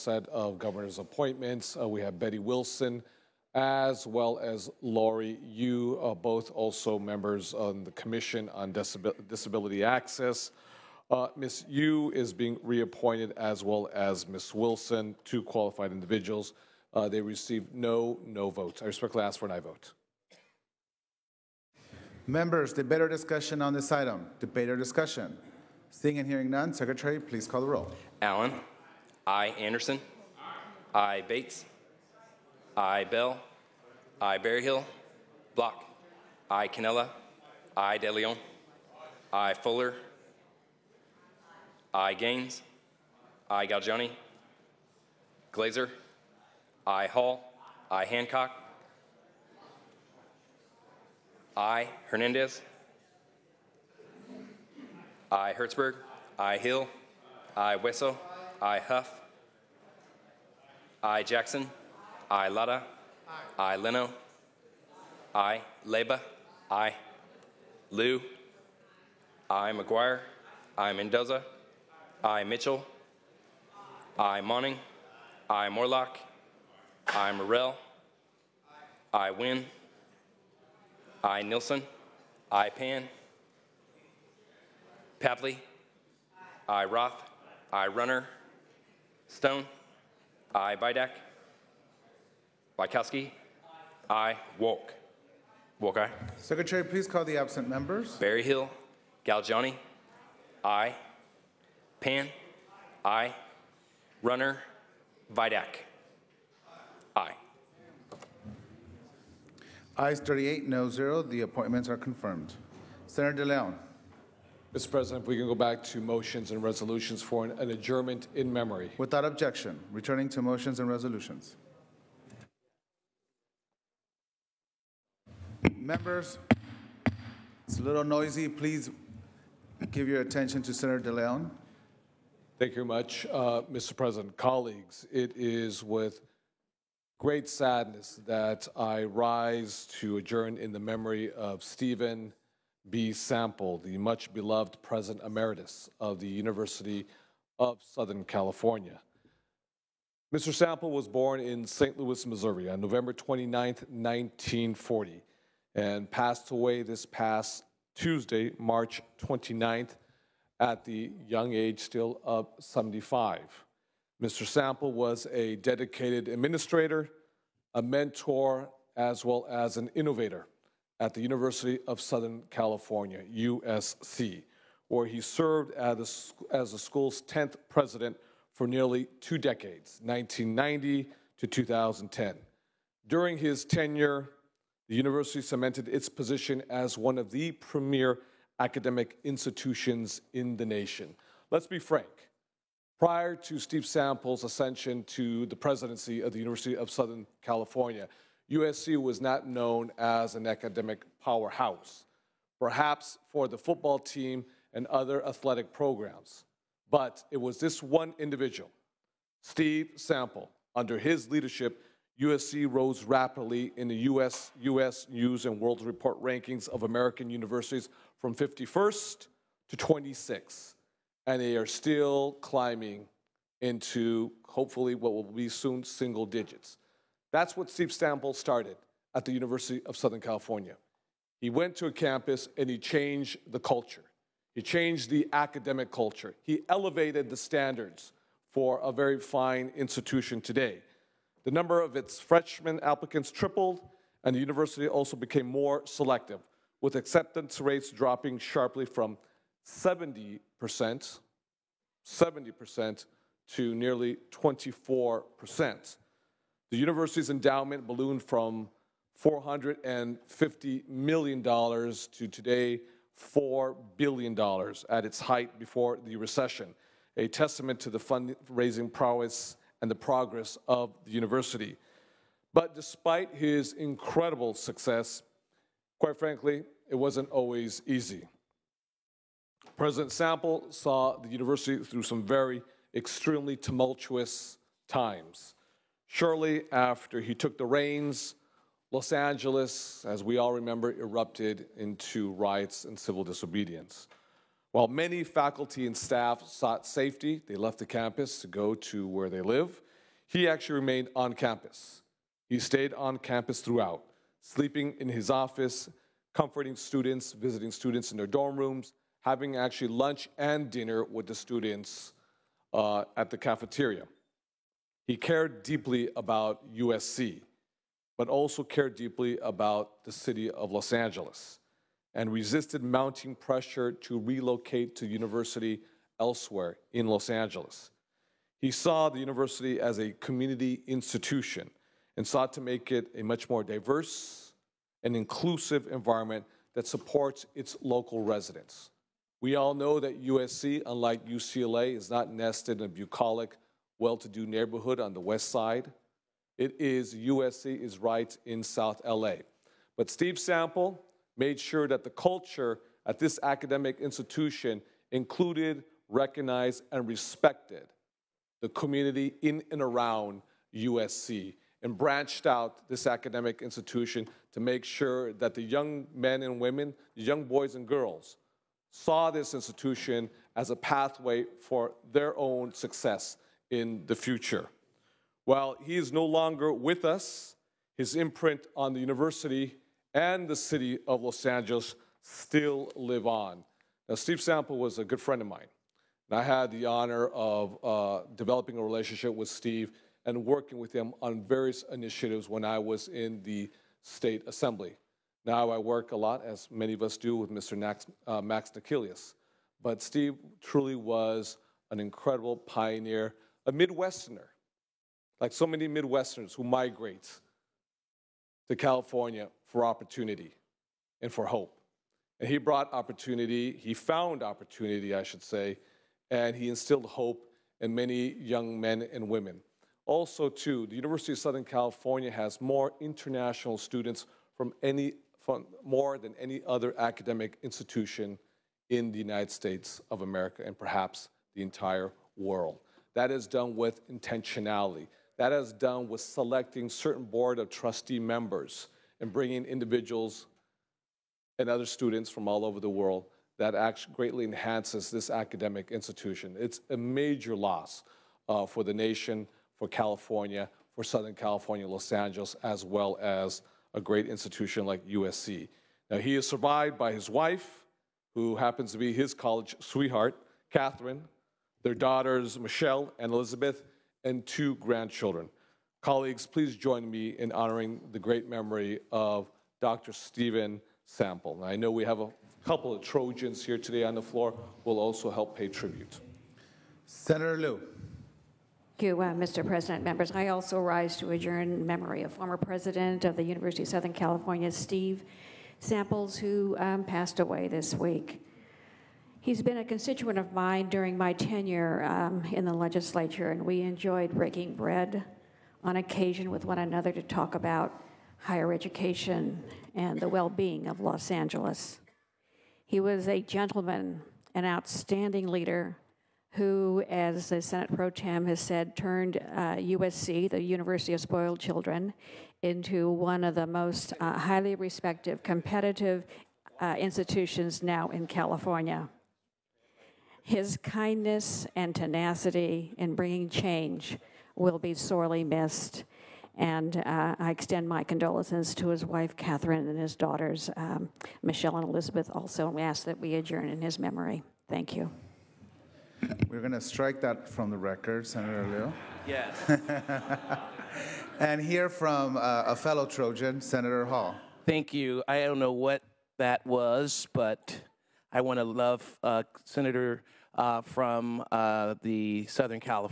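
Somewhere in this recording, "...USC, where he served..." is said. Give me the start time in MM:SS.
02:53.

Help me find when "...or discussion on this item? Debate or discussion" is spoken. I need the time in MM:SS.
00:23.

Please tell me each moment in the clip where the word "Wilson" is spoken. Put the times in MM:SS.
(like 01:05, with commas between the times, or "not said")
00:02, 00:14.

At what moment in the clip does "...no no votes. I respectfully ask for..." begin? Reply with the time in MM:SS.
00:17.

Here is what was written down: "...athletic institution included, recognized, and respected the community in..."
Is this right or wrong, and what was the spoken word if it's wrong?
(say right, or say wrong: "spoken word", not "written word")
wrong: "academic", not "athletic".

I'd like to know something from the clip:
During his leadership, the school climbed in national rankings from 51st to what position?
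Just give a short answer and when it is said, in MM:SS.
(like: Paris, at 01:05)
26th, at 03:39.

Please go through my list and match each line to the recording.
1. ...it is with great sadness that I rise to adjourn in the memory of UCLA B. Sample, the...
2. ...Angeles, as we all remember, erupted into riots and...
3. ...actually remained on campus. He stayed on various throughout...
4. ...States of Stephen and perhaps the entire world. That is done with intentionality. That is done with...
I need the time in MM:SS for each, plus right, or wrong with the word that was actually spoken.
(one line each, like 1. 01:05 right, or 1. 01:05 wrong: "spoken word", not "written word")
1. 02:15 wrong: "Stephen", not "UCLA"
2. 04:49 right
3. 05:00 wrong: "campus", not "various"
4. 07:09 wrong: "America", not "Stephen".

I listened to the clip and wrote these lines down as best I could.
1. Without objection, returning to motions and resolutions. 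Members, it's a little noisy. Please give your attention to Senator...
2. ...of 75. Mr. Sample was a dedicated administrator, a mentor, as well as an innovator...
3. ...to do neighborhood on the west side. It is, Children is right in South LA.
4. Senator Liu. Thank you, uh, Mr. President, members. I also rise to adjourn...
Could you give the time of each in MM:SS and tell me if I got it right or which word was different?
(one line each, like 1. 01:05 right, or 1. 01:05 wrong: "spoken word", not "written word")
1. 01:58 right
2. 02:42 right
3. 05:44 wrong: "USC", not "Children"
4. 07:57 right.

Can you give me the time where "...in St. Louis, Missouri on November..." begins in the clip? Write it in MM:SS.
02:31.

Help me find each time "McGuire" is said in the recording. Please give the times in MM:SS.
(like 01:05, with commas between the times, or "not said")
01:09.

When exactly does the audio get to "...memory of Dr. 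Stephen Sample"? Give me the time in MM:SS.
07:48.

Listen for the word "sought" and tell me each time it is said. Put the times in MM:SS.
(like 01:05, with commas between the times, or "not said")
04:56, 05:32.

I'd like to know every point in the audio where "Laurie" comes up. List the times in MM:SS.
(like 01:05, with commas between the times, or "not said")
00:04.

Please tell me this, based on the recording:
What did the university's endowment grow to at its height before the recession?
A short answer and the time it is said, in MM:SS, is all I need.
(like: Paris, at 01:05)
$4 billion, at 04:23.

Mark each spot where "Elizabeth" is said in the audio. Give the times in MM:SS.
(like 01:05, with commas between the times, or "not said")
07:43, 08:51.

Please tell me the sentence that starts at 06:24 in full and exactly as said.
Now, Steve Sample was a good friend of mine.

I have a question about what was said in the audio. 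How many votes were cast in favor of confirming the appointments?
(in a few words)
38.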